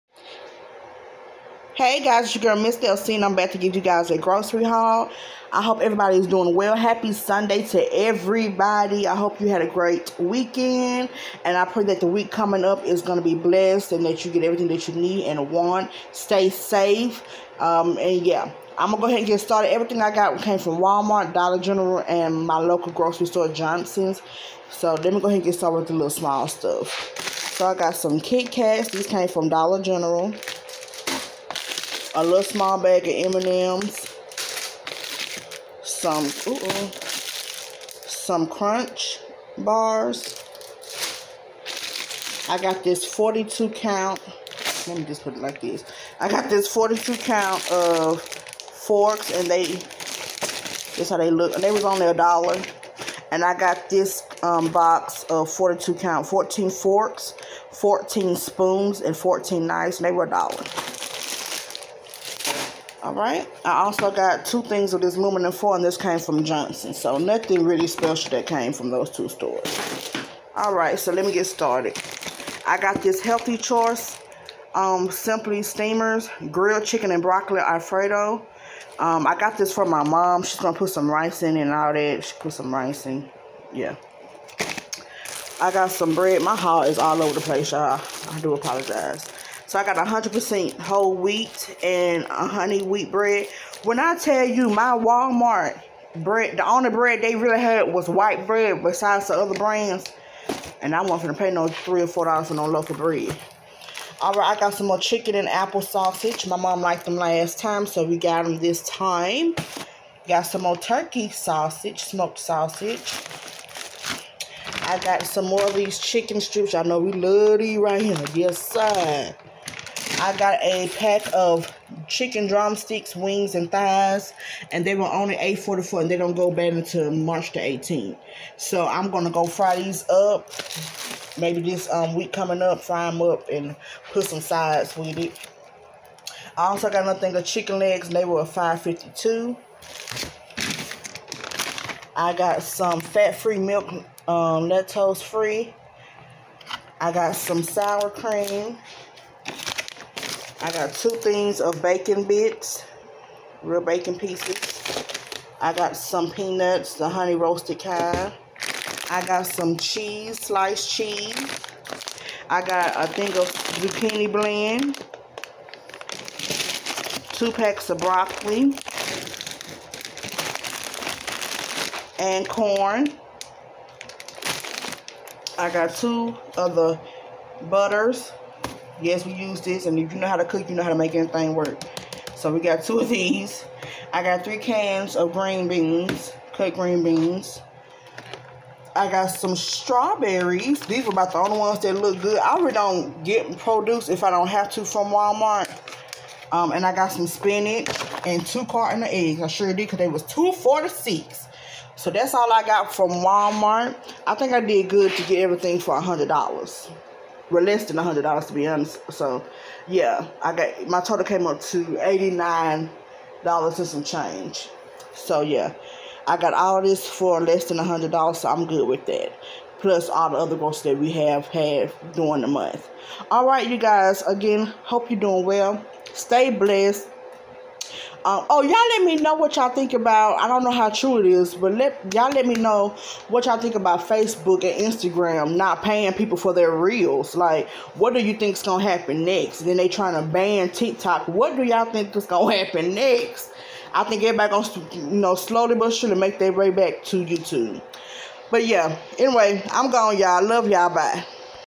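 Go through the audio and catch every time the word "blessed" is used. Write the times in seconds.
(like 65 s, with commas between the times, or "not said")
13 s, 226 s.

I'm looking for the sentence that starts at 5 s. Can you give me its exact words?
I hope everybody is doing well.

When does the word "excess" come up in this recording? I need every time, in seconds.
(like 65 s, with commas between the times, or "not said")
not said.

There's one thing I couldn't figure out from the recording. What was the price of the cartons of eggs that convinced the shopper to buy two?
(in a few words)
$2.46.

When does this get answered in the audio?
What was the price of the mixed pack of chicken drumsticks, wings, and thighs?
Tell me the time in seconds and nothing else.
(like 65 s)
125 s.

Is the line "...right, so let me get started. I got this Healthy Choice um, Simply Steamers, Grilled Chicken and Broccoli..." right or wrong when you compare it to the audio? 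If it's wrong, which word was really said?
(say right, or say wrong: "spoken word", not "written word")
right.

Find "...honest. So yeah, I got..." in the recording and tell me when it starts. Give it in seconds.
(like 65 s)
208 s.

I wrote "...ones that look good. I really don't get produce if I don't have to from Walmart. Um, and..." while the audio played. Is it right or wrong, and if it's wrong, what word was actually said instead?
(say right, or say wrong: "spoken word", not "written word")
right.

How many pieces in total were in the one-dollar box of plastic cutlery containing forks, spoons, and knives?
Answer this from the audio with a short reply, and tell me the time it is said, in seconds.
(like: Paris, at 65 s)
42, at 54 s.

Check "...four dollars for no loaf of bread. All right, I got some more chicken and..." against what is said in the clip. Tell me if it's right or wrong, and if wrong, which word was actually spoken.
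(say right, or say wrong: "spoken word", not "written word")
right.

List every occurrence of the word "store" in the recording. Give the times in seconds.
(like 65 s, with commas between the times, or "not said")
23 s, 69 s.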